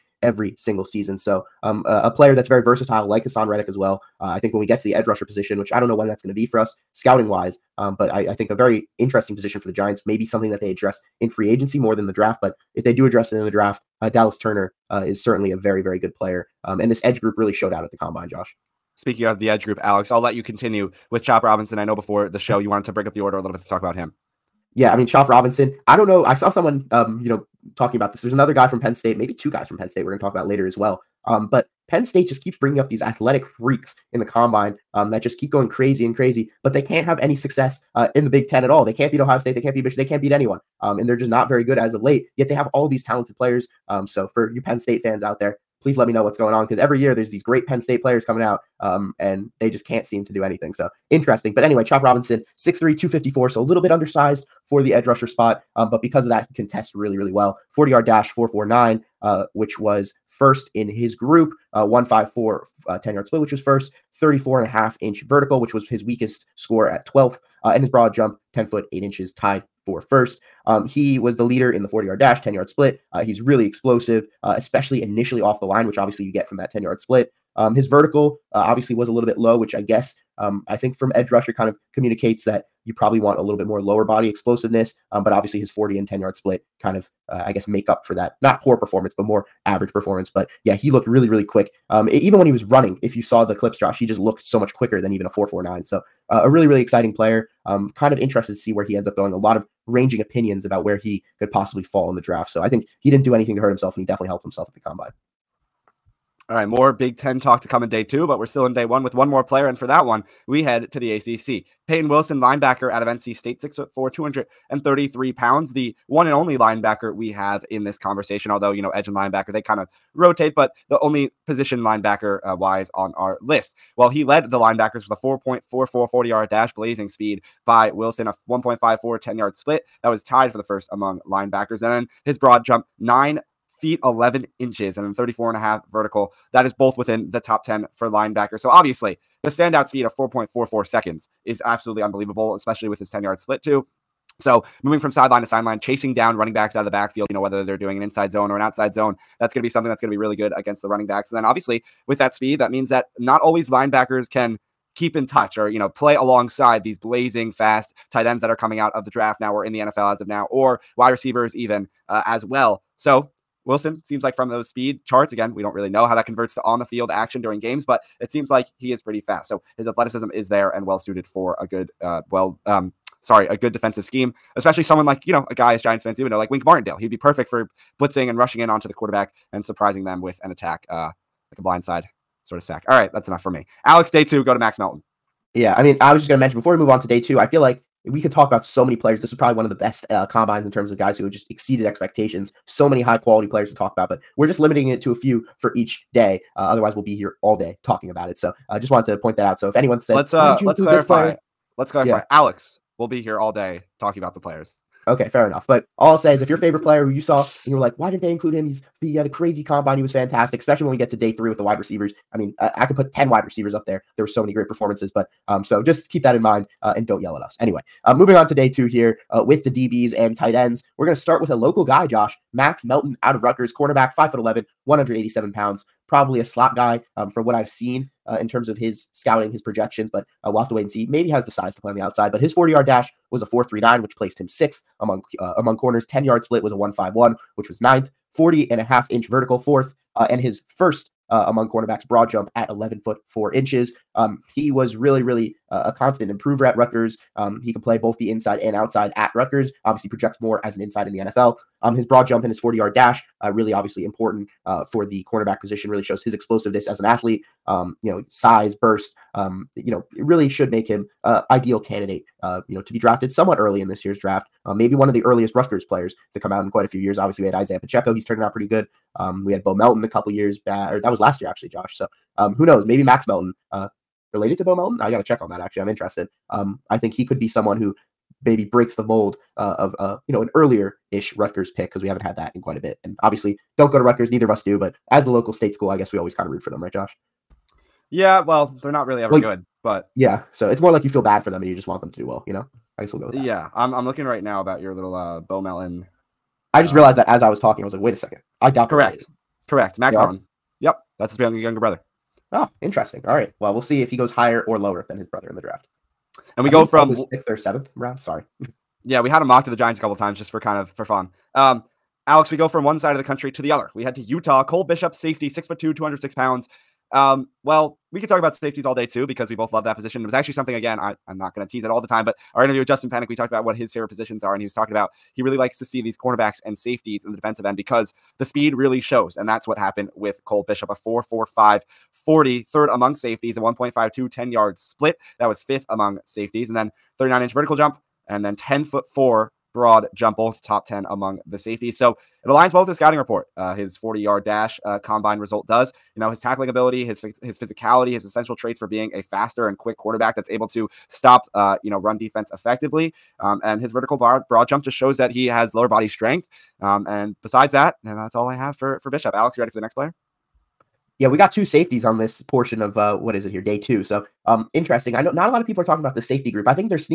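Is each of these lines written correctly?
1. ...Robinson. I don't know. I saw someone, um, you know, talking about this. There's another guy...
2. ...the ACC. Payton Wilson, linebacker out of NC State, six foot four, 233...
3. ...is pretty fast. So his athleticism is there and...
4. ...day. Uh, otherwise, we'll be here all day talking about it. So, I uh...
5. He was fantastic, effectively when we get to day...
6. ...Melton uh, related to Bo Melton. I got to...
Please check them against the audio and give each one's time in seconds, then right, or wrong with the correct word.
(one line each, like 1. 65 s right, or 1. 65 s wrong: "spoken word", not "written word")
1. 25 s right
2. 110 s right
3. 168 s right
4. 196 s right
5. 209 s wrong: "especially", not "effectively"
6. 273 s right.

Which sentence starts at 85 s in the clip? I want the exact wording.
Um, but obviously, his 40 and 10 yard split kind of, uh, I guess, make up for that.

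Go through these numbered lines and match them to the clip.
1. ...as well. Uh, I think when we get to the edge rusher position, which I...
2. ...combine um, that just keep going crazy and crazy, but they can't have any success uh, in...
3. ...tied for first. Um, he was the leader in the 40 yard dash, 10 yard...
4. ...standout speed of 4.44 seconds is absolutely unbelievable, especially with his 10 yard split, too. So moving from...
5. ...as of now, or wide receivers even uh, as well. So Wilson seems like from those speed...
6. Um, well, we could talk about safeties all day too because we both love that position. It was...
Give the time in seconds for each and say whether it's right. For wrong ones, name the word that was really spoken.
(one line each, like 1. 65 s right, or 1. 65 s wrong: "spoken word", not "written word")
1. 3 s right
2. 34 s right
3. 69 s right
4. 139 s right
5. 160 s right
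6. 317 s right.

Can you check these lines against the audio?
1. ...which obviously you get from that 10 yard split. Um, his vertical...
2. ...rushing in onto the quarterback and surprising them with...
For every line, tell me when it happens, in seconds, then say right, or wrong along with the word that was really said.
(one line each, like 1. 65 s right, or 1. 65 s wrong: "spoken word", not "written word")
1. 75 s right
2. 178 s right.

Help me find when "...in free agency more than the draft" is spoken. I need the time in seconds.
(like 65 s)
11 s.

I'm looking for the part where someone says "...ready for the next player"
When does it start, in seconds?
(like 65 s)
359 s.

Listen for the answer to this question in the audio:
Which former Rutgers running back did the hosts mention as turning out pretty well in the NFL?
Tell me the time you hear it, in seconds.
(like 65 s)
267 s.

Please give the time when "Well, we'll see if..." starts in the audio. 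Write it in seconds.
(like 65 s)
303 s.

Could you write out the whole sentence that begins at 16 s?
Um, and this edge group really showed out at the combine, Josh.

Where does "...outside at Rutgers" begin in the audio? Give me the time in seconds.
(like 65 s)
248 s.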